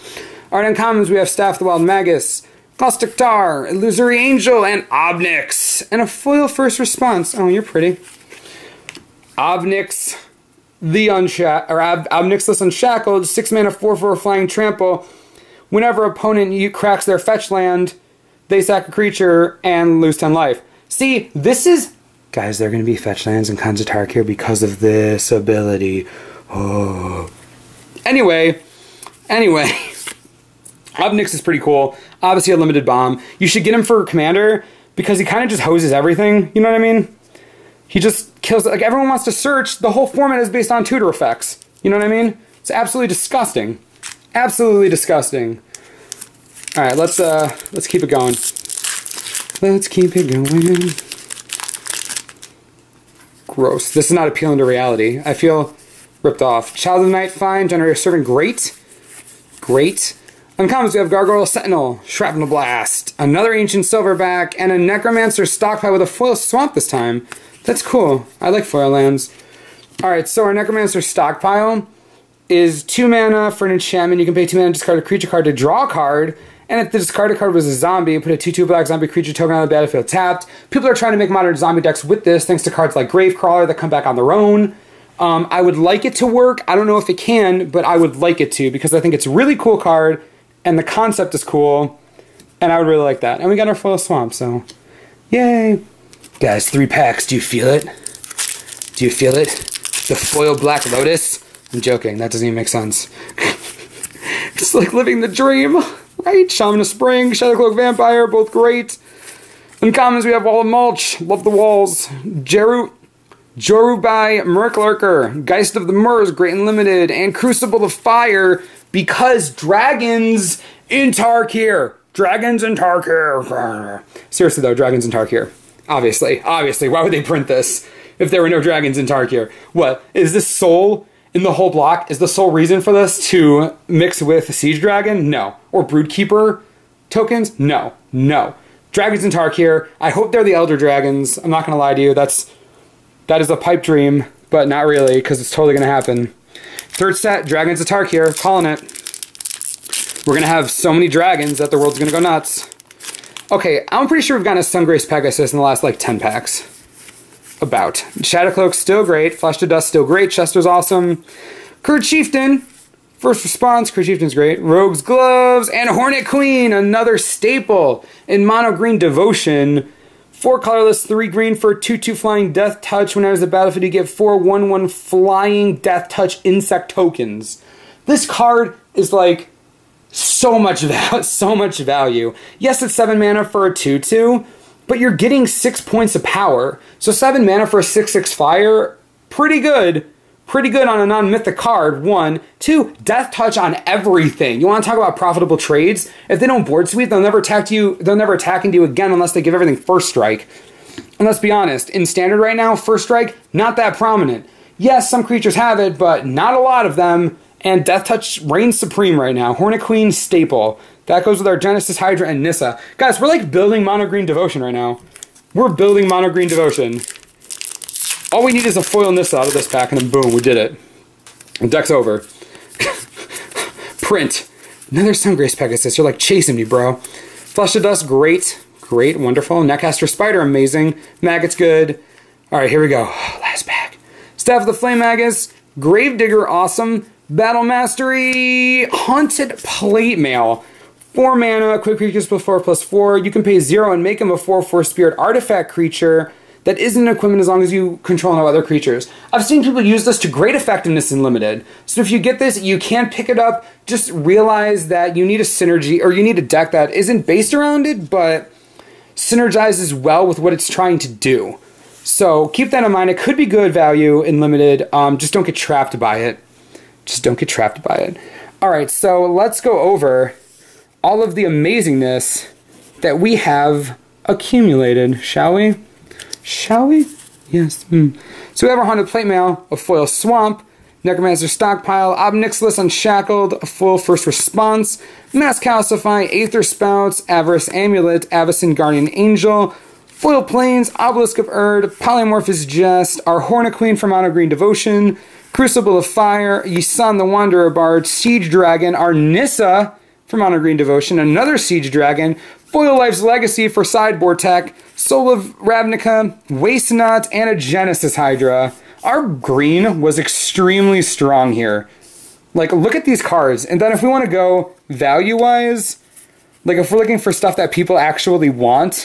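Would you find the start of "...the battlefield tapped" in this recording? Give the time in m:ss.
1:19.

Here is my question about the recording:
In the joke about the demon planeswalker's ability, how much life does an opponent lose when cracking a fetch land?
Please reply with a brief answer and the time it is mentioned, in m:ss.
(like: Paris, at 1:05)
10, at 0:20.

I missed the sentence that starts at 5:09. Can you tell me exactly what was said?
Our green was extremely strong here.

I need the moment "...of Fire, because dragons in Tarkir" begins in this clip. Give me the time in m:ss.
1:57.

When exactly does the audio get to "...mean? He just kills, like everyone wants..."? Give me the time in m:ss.
0:36.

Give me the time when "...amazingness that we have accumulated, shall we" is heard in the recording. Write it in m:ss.
4:31.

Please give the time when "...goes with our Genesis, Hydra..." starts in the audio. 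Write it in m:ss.
3:31.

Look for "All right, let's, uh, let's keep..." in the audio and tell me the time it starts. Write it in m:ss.
0:46.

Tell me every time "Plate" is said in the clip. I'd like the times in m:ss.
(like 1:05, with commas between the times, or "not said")
3:59, 4:39.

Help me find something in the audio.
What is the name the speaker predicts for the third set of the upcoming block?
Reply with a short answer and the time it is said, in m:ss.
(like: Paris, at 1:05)
Dragons of Tarkir, at 2:27.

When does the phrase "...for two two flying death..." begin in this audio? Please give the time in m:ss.
2:51.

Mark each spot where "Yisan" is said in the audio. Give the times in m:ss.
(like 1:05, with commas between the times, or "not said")
4:56.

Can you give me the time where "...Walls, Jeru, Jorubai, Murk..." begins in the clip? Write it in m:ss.
1:51.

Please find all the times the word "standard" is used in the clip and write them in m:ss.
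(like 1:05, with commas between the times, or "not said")
3:22.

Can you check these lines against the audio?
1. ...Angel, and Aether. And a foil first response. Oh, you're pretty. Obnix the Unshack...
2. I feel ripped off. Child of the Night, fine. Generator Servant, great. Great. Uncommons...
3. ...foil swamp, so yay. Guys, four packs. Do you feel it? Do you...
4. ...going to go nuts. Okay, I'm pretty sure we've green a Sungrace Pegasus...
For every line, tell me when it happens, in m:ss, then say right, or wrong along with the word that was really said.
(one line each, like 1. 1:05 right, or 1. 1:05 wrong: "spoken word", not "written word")
1. 0:04 wrong: "Obnix", not "Aether"
2. 0:55 right
3. 1:33 wrong: "three", not "four"
4. 2:31 wrong: "gotten", not "green".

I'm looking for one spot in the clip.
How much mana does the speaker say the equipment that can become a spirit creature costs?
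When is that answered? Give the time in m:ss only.
4:01.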